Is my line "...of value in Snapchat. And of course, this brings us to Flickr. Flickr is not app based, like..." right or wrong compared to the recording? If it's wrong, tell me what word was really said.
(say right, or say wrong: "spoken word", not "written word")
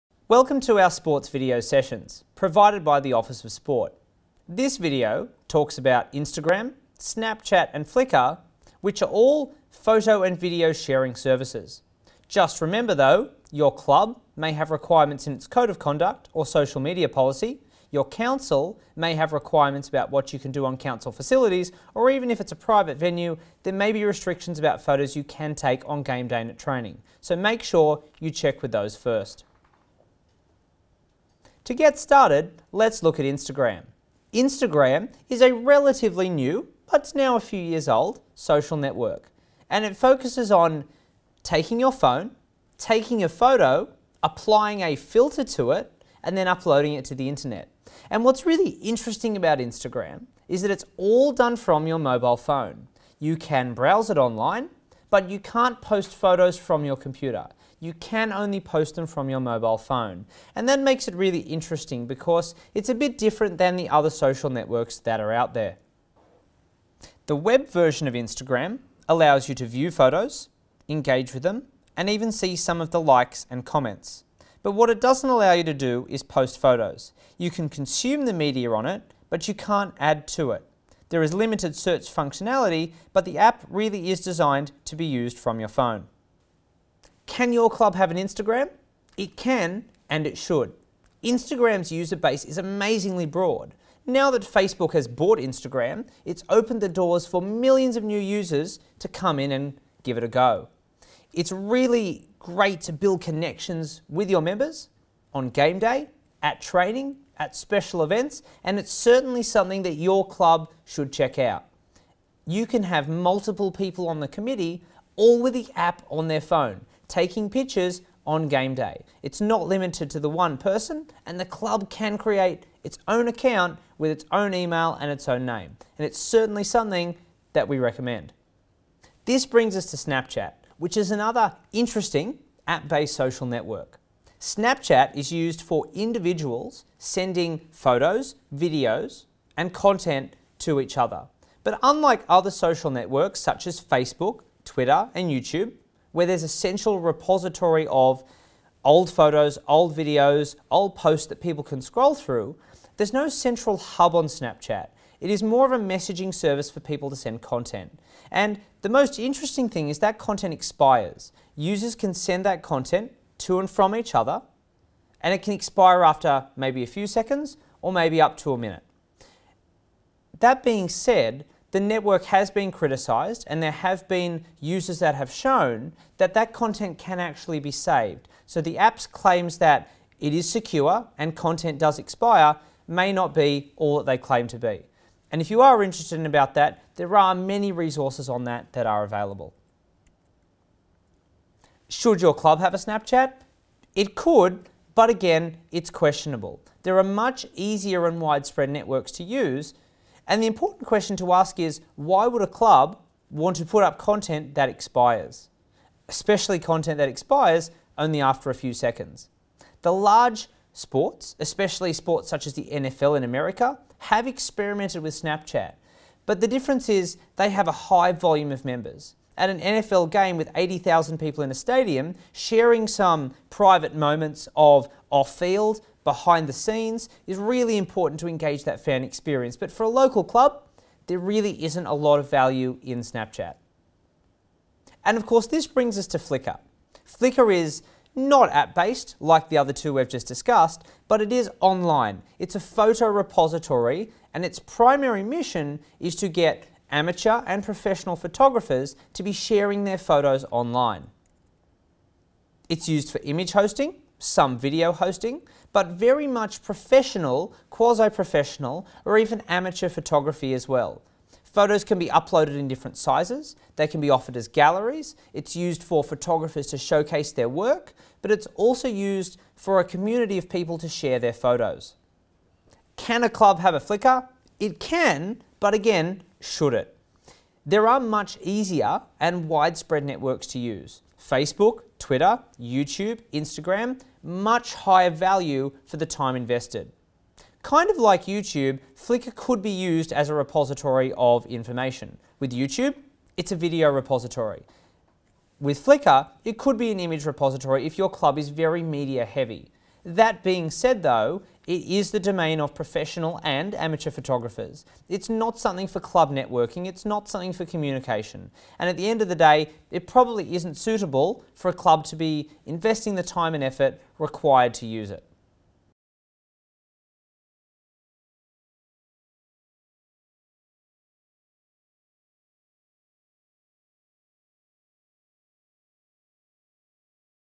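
right.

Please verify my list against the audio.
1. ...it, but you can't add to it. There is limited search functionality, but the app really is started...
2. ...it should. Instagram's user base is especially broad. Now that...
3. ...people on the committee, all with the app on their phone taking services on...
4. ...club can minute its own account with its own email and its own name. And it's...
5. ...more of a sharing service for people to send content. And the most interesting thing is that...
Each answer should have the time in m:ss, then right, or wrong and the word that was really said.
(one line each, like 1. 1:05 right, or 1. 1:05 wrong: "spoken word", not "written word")
1. 1:18 wrong: "designed", not "started"
2. 1:30 wrong: "amazingly", not "especially"
3. 1:53 wrong: "pictures", not "services"
4. 2:01 wrong: "create", not "minute"
5. 2:35 wrong: "messaging", not "sharing".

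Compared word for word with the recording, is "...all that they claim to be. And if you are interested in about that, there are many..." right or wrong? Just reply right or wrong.
right.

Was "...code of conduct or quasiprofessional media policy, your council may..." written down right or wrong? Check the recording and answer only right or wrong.
wrong.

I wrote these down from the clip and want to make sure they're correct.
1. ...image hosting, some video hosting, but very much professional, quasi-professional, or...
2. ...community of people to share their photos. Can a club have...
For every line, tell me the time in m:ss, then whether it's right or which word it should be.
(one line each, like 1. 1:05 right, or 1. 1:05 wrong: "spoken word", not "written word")
1. 4:13 right
2. 4:29 right.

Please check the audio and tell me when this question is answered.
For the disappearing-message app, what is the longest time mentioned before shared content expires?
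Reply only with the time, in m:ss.
2:48.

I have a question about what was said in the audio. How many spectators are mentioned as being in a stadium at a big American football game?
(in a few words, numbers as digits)
80,000.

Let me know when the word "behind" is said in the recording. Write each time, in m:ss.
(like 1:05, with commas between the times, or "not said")
3:46.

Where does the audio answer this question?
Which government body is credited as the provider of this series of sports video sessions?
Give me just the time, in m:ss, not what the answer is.
0:03.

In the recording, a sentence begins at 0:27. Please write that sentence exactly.
So make sure you check with those first.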